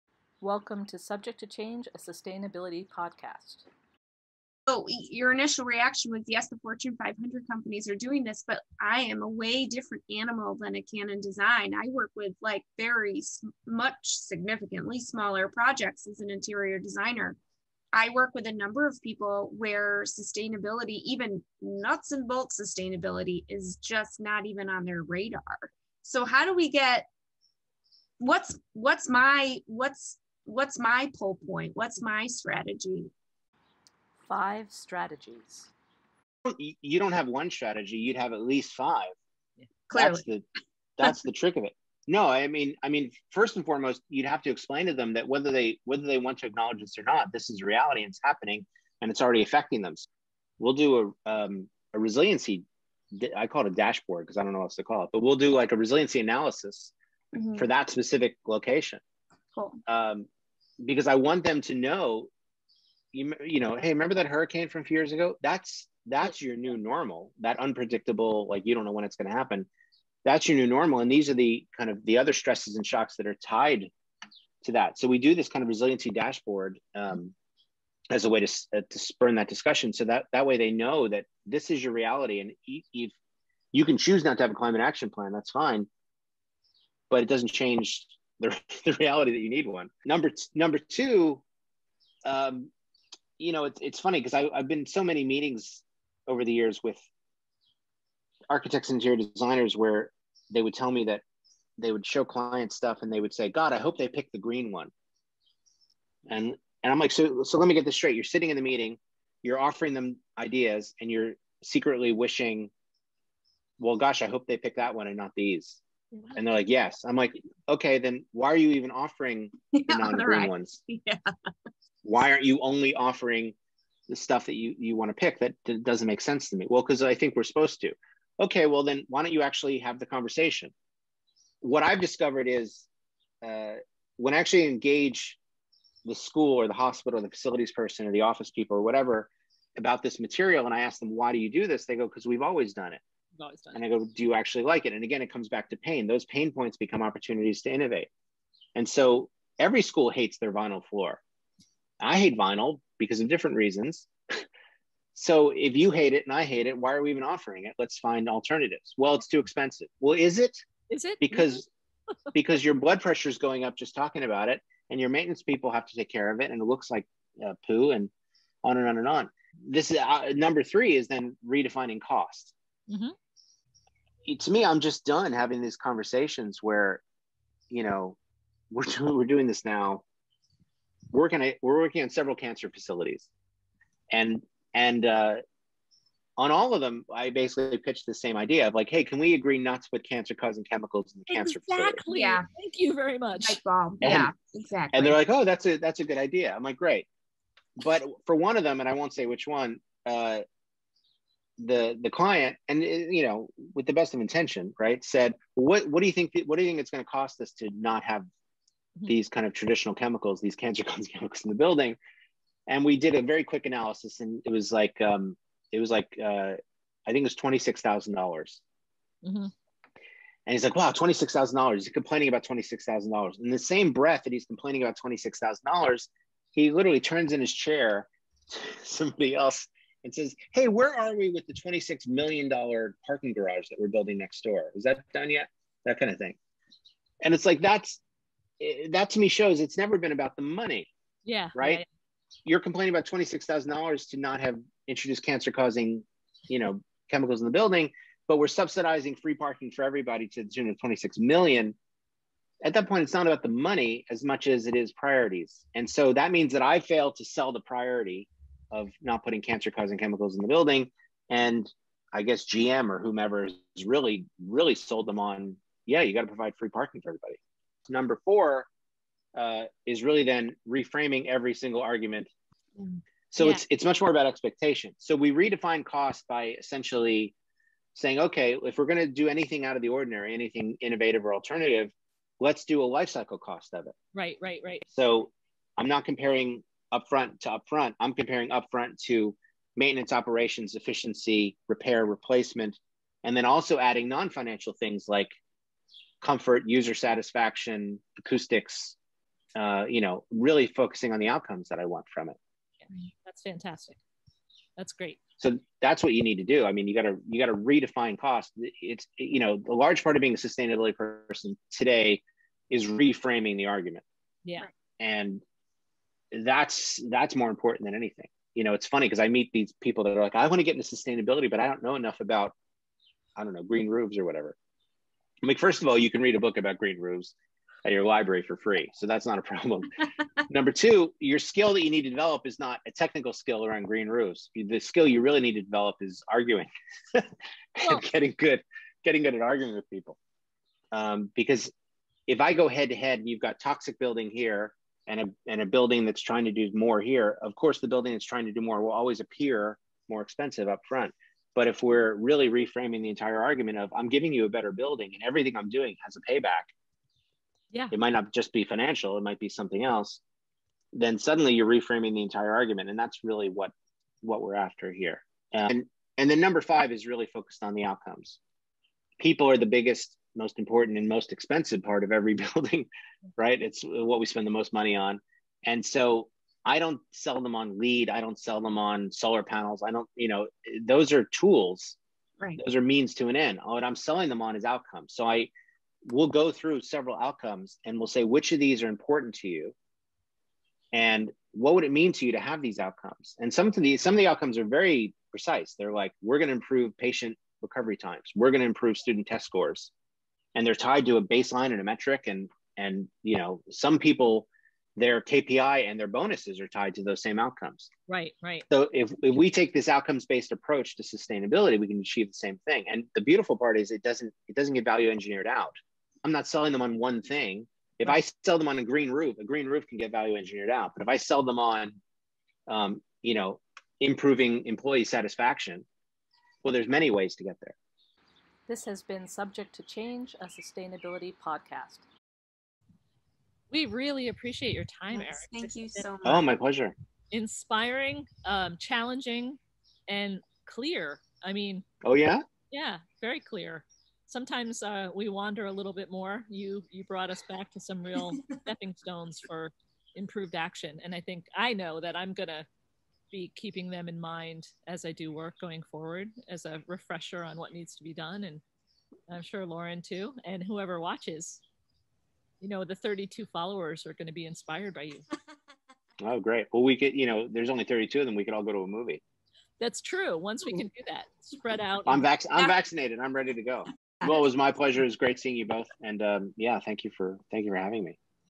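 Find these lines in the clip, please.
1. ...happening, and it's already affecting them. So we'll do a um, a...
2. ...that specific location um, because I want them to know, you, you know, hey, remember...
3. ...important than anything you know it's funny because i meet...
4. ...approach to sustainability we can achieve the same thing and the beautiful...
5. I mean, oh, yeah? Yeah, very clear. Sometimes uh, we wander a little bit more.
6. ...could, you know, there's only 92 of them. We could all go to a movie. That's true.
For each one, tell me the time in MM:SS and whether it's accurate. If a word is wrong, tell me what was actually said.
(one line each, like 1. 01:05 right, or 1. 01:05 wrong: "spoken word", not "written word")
1. 00:48 right
2. 00:57 right
3. 05:17 right
4. 06:50 right
5. 07:21 right
6. 07:46 wrong: "32", not "92".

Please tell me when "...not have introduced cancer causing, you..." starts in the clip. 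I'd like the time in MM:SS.
04:04.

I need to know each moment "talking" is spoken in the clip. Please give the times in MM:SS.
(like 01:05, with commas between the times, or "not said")
02:43.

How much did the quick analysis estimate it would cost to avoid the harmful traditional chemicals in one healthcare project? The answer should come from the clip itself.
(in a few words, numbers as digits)
$26,000.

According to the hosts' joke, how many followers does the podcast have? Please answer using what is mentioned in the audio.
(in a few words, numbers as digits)
32.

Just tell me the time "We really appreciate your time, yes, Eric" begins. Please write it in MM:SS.
07:13.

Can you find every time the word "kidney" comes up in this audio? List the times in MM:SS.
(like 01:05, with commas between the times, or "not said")
not said.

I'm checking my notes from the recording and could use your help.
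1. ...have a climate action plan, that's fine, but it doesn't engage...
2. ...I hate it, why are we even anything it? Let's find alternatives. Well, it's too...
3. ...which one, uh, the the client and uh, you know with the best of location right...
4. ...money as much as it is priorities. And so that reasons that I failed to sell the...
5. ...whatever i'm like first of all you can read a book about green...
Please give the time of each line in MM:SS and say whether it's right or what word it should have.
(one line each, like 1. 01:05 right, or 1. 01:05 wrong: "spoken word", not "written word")
1. 01:24 wrong: "change", not "engage"
2. 02:36 wrong: "offering", not "anything"
3. 03:19 wrong: "intention", not "location"
4. 04:13 wrong: "means", not "reasons"
5. 05:24 right.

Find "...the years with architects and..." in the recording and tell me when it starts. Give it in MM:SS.
01:36.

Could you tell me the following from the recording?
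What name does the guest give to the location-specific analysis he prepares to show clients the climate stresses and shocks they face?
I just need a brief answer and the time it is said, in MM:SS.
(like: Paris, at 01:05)
resiliency dashboard, at 01:15.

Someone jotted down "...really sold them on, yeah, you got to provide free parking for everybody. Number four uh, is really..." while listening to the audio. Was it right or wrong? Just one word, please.
right.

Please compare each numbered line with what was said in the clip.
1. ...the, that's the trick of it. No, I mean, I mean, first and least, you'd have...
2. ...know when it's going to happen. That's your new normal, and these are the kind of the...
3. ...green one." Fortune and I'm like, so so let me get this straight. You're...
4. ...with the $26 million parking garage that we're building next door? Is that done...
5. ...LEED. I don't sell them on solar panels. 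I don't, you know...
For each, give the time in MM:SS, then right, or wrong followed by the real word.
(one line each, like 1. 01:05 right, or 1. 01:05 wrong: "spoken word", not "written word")
1. 00:40 wrong: "foremost", not "least"
2. 01:08 right
3. 01:44 wrong: "And", not "Fortune"
4. 03:51 right
5. 06:17 right.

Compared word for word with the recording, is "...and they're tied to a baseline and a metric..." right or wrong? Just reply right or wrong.
right.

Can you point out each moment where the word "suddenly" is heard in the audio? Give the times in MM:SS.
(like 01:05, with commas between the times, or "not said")
06:01.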